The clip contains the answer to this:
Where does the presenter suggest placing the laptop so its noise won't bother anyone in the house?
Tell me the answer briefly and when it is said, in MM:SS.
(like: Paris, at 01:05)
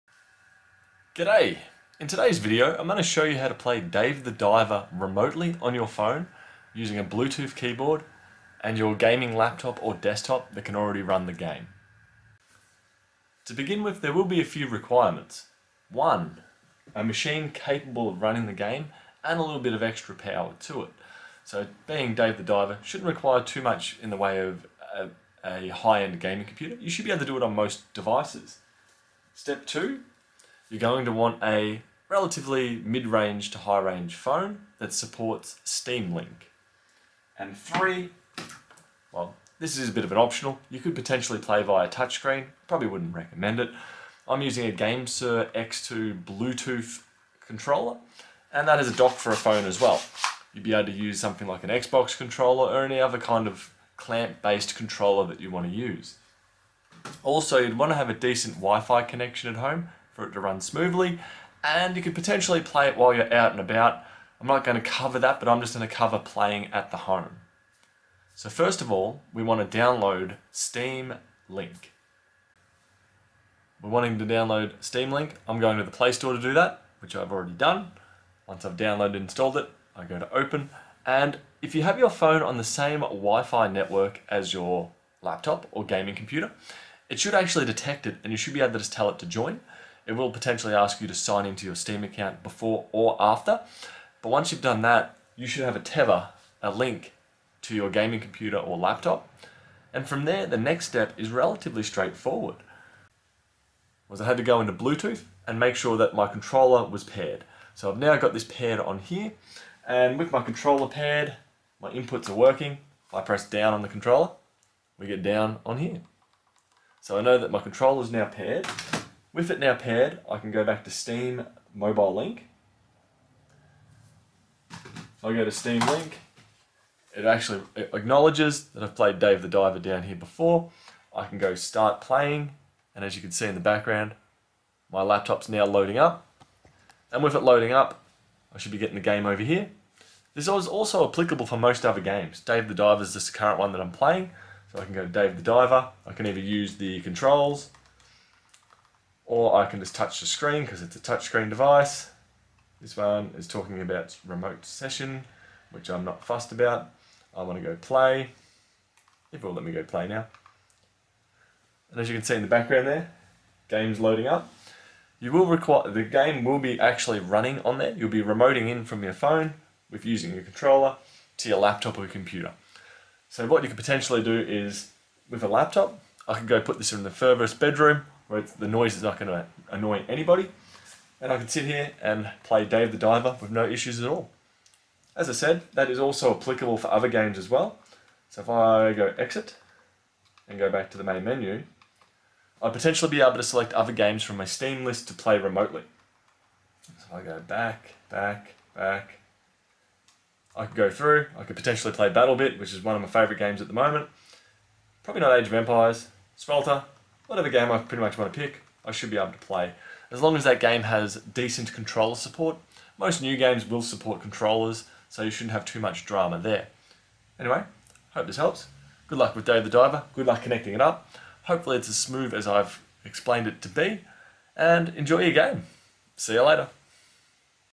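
the furthest bedroom, at 02:57.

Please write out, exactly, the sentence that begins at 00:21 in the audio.
So being Dave the Diver shouldn't require too much in the way of a, a high-end gaming computer.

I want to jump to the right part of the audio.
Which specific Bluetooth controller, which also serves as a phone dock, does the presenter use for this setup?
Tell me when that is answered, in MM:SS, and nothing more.
00:44.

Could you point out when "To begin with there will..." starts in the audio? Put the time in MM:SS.
00:13.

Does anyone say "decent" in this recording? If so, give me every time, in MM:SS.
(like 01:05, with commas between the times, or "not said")
00:58, 03:31.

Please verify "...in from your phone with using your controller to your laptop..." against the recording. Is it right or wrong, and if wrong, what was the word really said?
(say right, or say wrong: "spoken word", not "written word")
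right.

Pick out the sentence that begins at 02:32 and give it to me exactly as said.
This one is talking about remote session, which I'm not fussed about.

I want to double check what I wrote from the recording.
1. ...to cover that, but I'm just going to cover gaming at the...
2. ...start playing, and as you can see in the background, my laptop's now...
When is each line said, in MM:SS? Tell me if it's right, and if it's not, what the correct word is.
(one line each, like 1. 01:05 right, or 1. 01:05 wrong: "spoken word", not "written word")
1. 01:04 wrong: "playing", not "gaming"
2. 02:11 right.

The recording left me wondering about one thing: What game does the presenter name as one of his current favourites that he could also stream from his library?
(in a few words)
Battlebit.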